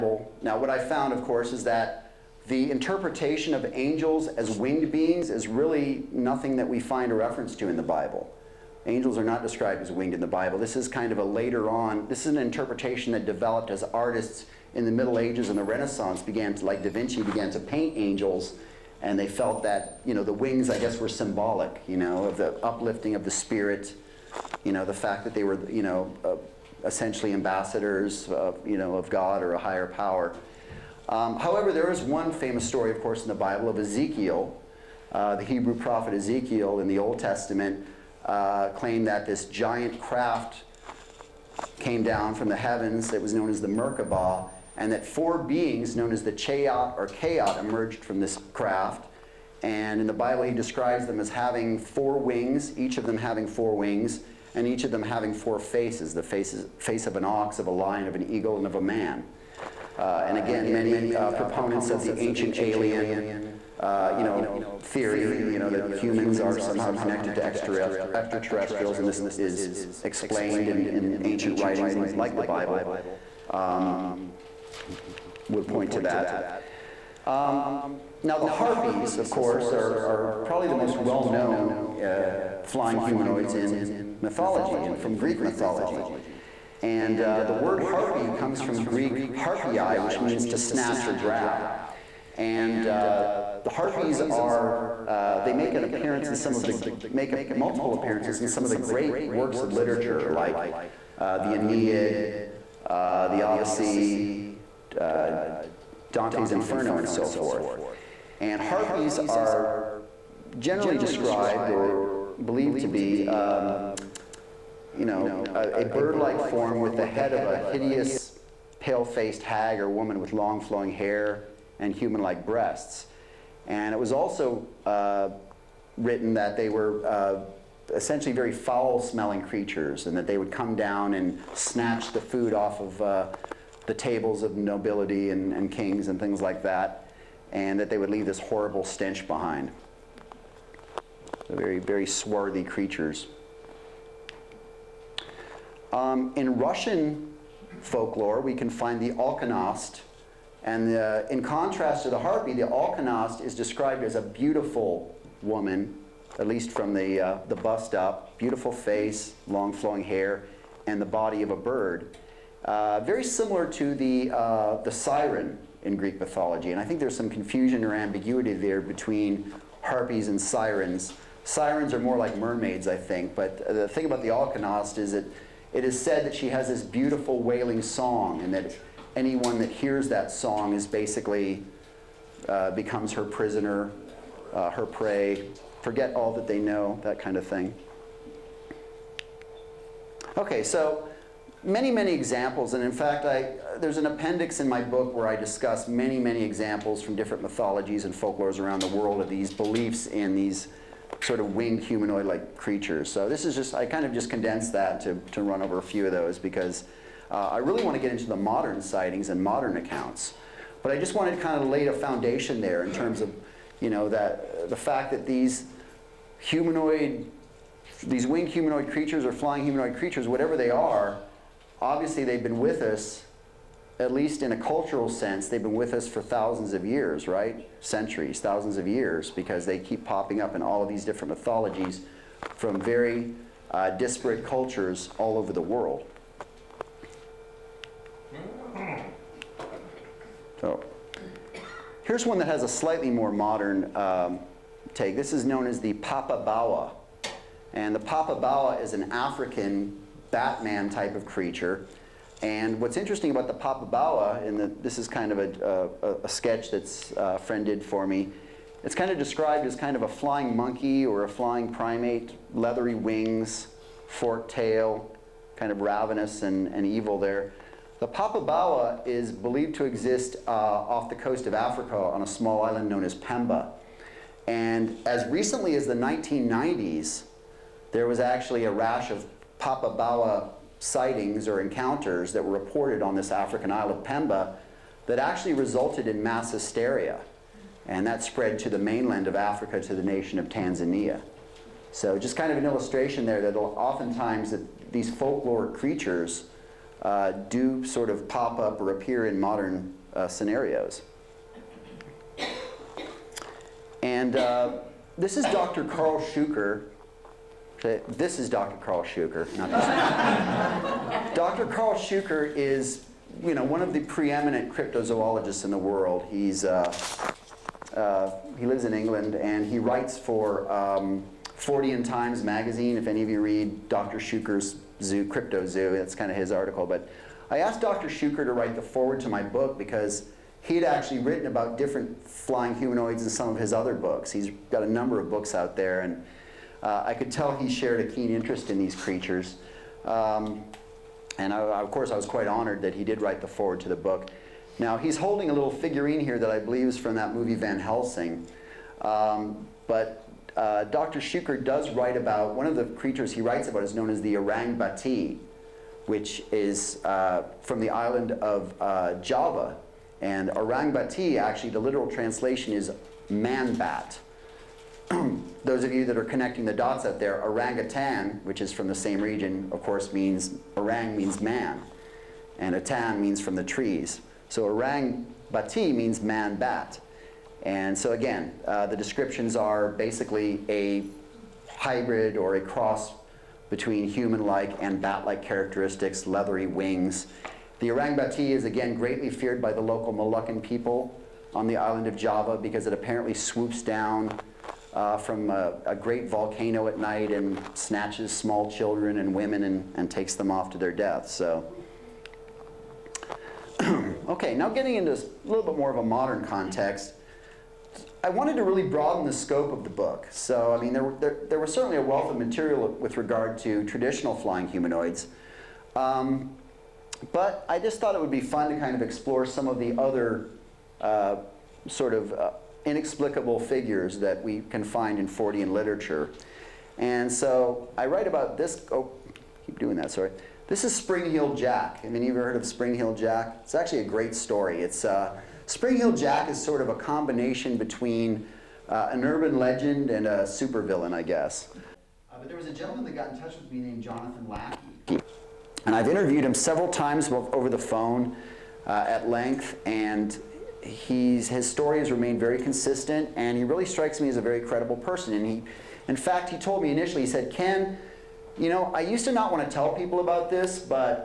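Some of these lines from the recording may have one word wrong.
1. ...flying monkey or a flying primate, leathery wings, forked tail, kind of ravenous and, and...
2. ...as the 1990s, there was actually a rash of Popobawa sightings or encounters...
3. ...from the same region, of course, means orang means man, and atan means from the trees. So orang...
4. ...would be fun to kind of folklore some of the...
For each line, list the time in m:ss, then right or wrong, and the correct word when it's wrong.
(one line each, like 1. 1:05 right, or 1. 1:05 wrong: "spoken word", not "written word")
1. 4:20 right
2. 4:35 right
3. 6:08 right
4. 6:58 wrong: "explore", not "folklore".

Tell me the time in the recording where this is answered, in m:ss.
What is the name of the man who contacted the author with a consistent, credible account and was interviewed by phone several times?
7:24.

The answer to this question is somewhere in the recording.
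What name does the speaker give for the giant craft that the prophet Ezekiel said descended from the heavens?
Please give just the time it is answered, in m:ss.
0:43.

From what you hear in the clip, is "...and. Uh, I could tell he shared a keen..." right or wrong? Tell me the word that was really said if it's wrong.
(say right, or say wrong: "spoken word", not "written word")
right.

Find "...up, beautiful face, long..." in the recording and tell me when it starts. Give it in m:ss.
2:37.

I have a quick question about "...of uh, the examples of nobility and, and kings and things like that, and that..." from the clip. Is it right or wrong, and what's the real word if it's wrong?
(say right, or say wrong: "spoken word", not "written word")
wrong: "tables", not "examples".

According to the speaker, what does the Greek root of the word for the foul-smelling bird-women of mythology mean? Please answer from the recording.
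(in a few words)
to snatch or grab.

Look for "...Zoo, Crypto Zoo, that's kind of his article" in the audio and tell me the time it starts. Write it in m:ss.
5:25.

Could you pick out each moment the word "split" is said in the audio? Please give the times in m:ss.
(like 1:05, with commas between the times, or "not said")
not said.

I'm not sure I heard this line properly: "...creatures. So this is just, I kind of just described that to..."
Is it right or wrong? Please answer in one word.
wrong.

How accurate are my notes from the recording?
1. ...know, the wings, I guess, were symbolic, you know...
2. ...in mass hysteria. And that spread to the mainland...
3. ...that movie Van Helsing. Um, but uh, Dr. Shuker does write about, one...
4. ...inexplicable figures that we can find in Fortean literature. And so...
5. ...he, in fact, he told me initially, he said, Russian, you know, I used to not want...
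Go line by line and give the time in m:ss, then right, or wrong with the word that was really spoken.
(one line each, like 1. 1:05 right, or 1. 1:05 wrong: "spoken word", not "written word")
1. 0:20 right
2. 4:46 right
3. 5:47 right
4. 7:02 right
5. 7:35 wrong: "Ken", not "Russian".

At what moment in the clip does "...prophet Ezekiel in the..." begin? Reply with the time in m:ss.
0:35.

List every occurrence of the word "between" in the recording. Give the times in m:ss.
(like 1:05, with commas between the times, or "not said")
2:48, 6:23, 7:17.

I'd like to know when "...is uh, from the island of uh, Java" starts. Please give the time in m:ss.
5:56.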